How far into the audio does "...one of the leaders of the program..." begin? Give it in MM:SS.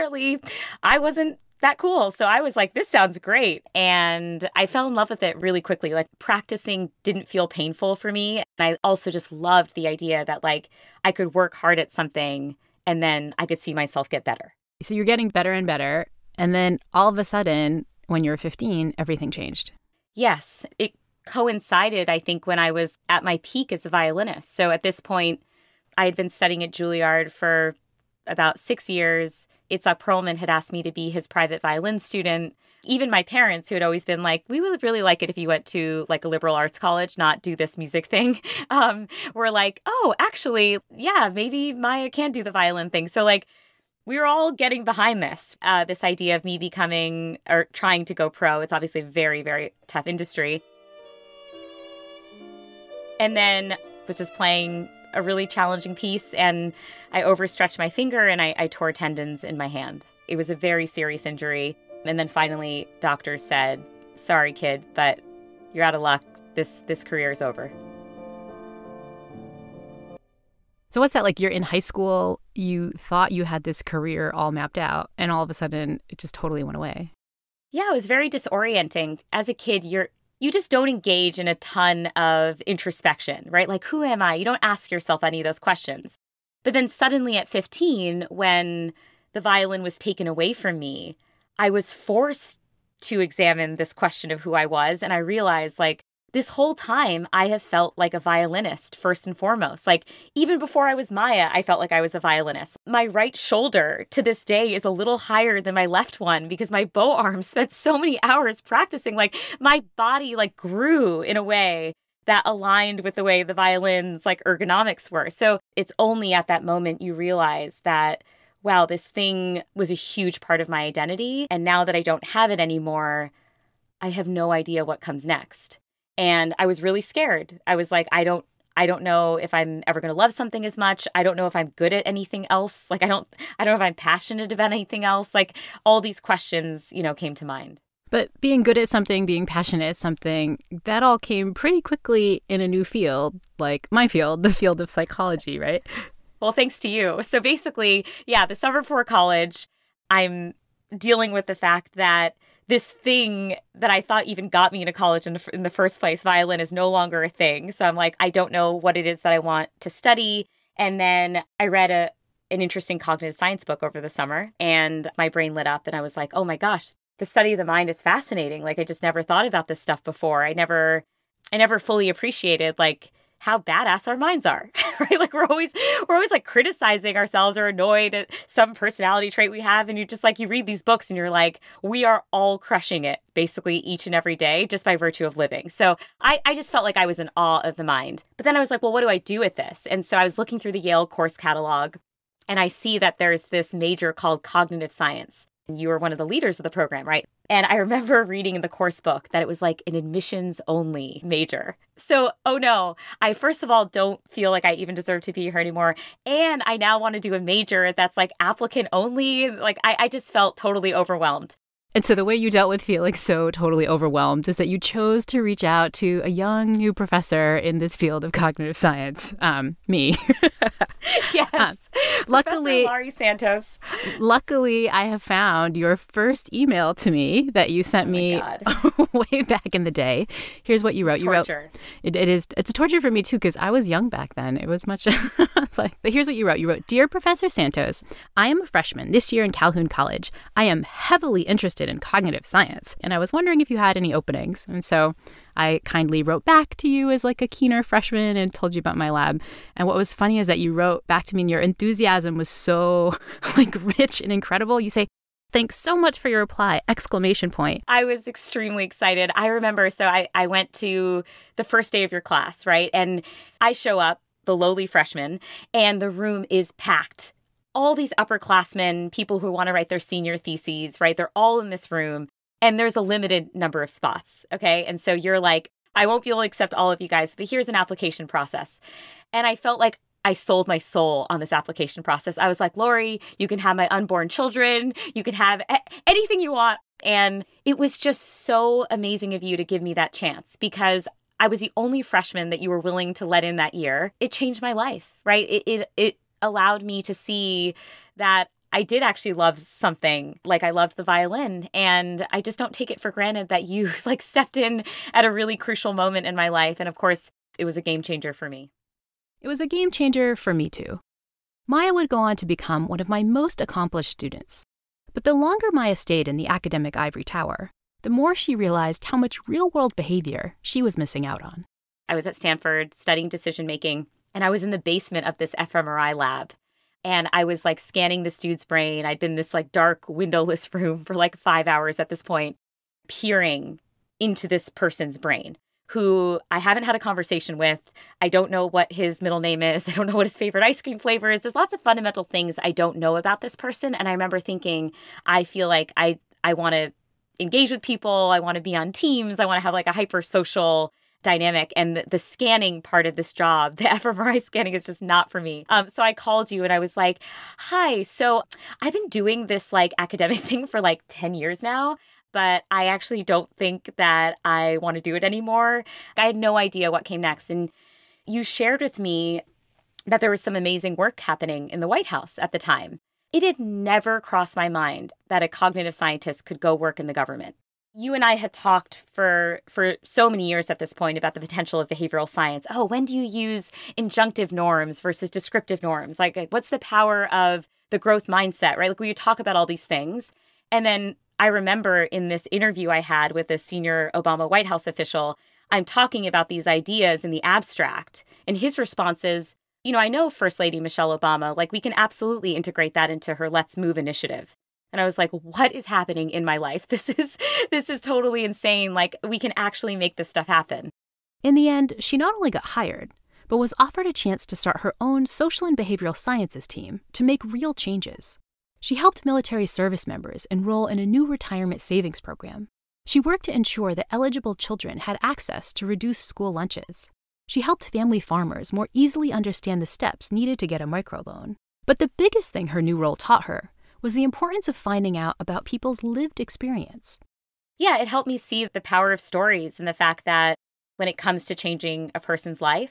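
03:15.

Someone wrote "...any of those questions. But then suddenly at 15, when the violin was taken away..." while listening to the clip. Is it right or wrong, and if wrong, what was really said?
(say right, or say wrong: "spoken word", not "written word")
right.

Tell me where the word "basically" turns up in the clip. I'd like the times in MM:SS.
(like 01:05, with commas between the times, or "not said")
02:27, 03:03.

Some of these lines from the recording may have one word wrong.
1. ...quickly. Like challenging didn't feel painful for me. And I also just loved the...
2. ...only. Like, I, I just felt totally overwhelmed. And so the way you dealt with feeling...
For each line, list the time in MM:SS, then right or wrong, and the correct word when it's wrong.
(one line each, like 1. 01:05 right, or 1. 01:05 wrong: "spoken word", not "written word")
1. 00:05 wrong: "practicing", not "challenging"
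2. 03:28 right.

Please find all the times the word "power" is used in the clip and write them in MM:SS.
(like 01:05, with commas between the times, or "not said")
06:26, 07:18.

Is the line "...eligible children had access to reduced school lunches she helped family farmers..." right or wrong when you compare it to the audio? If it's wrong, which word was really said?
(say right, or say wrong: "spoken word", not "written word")
right.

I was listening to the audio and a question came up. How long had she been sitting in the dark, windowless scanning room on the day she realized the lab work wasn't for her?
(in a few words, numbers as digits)
5 hours.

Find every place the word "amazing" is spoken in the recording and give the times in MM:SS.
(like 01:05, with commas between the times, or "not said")
04:48, 06:10.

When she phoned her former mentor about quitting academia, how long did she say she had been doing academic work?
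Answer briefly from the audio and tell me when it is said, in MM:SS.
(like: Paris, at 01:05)
10 years, at 06:01.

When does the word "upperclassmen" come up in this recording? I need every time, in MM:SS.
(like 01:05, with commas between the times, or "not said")
04:28.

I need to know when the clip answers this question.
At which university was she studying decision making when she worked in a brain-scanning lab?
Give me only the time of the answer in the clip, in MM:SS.
05:22.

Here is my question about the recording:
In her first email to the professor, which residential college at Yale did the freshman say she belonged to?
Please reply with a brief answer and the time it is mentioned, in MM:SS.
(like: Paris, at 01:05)
Calhoun College, at 03:59.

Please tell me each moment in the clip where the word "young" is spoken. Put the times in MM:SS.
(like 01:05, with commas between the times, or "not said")
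03:36, 03:53.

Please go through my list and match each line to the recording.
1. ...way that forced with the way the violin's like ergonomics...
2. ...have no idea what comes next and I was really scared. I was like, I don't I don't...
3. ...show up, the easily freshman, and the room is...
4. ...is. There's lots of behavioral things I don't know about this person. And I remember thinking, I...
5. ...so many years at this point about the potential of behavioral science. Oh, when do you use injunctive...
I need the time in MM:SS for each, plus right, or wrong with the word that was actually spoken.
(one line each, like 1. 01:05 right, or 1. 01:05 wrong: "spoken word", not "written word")
1. 01:51 wrong: "aligned", not "forced"
2. 02:04 right
3. 04:23 wrong: "lowly", not "easily"
4. 05:41 wrong: "fundamental", not "behavioral"
5. 06:20 right.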